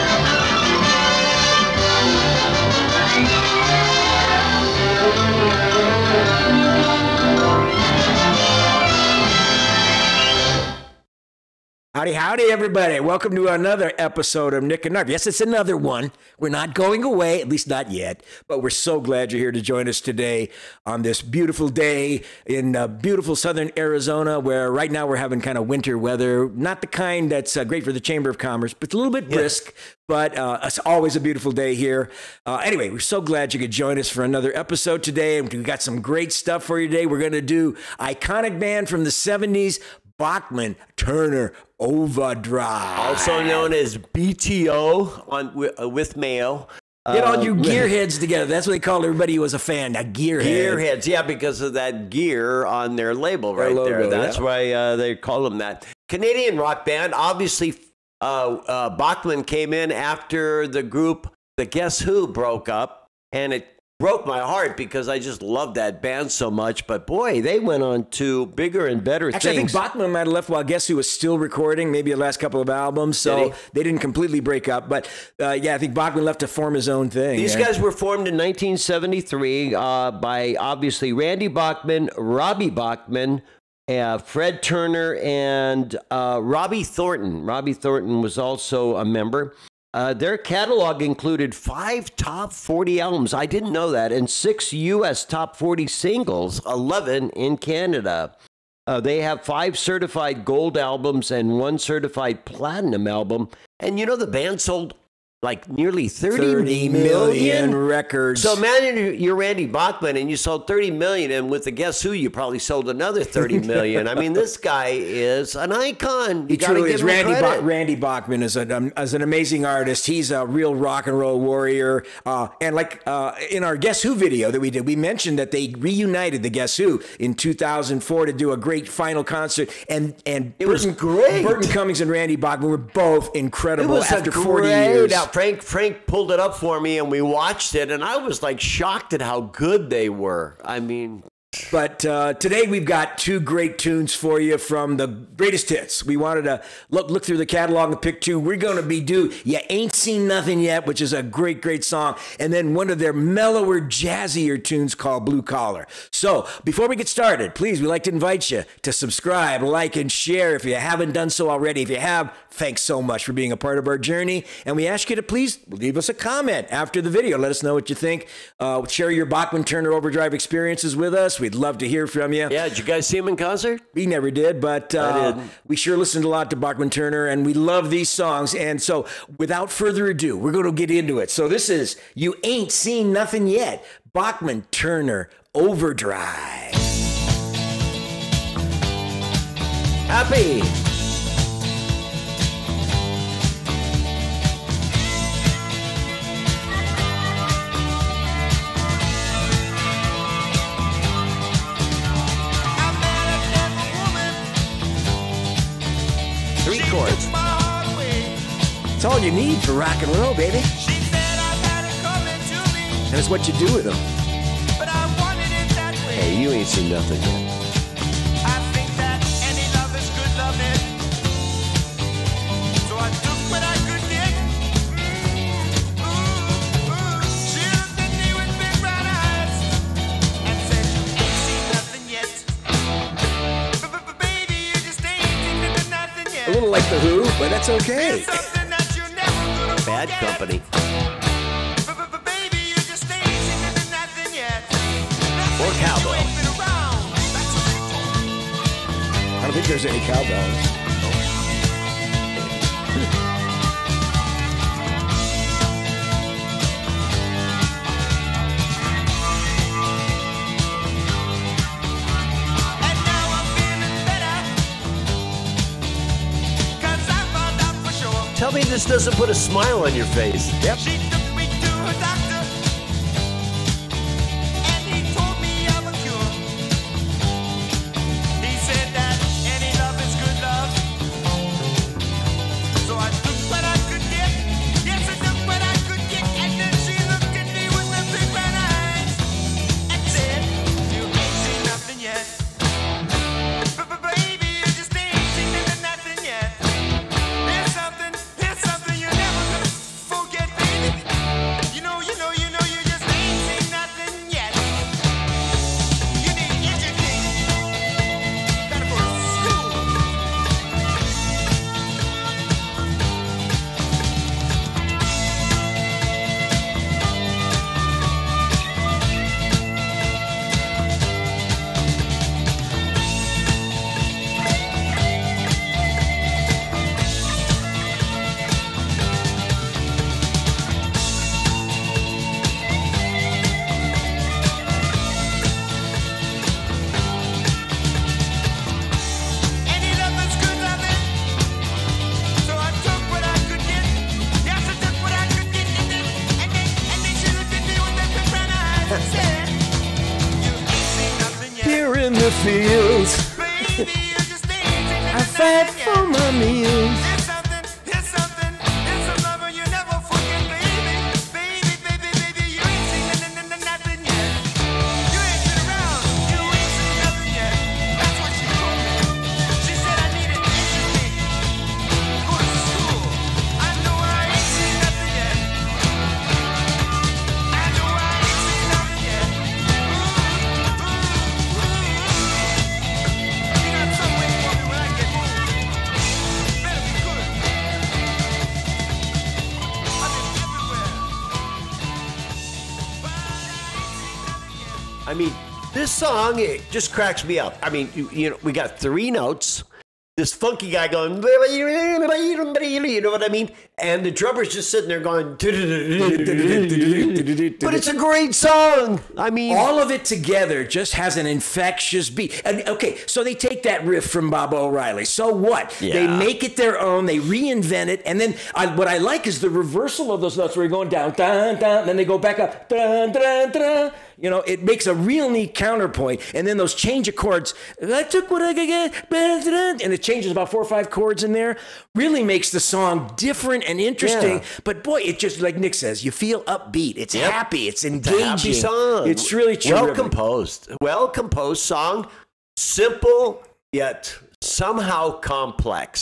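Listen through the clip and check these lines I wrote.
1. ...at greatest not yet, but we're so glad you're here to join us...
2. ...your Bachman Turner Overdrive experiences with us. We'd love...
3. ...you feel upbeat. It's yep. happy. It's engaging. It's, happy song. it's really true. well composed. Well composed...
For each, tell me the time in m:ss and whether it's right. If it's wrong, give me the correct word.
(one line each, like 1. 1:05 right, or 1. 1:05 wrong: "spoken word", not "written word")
1. 0:17 wrong: "least", not "greatest"
2. 2:49 right
3. 7:16 right.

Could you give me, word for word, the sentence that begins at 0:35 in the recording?
And we've got some great stuff for you today.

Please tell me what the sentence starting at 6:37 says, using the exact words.
I mean, you, you know, we got three notes.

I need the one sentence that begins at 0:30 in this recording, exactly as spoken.
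but uh, it's always a beautiful day here.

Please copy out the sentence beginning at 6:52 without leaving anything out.
And okay, so they take that riff from Baba O'Riley.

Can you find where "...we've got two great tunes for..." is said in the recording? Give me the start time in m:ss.
2:22.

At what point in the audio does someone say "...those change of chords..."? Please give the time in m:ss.
7:06.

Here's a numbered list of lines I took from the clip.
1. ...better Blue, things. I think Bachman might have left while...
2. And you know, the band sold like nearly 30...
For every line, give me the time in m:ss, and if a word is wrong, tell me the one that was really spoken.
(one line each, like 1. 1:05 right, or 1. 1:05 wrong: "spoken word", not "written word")
1. 1:09 wrong: "Actually", not "Blue"
2. 1:43 right.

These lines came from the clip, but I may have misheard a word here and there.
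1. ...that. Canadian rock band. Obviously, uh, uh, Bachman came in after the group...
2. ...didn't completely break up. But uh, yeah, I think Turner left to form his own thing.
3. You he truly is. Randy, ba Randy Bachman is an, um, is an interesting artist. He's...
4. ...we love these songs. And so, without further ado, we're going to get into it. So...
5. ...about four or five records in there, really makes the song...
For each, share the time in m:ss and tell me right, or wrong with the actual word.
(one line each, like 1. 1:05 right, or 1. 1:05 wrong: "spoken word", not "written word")
1. 0:55 right
2. 1:13 wrong: "Bachman", not "Turner"
3. 1:56 wrong: "amazing", not "interesting"
4. 2:57 right
5. 7:10 wrong: "chords", not "records".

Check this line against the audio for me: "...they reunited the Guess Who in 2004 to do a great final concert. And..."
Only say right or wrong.
right.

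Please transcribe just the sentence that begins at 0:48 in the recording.
That's what they called everybody who was a fan.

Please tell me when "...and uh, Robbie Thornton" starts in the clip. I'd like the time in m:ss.
1:25.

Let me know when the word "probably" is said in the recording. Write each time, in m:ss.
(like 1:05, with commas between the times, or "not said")
1:52.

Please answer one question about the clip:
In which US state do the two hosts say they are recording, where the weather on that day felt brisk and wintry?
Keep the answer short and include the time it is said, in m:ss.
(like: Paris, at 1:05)
Arizona, at 0:23.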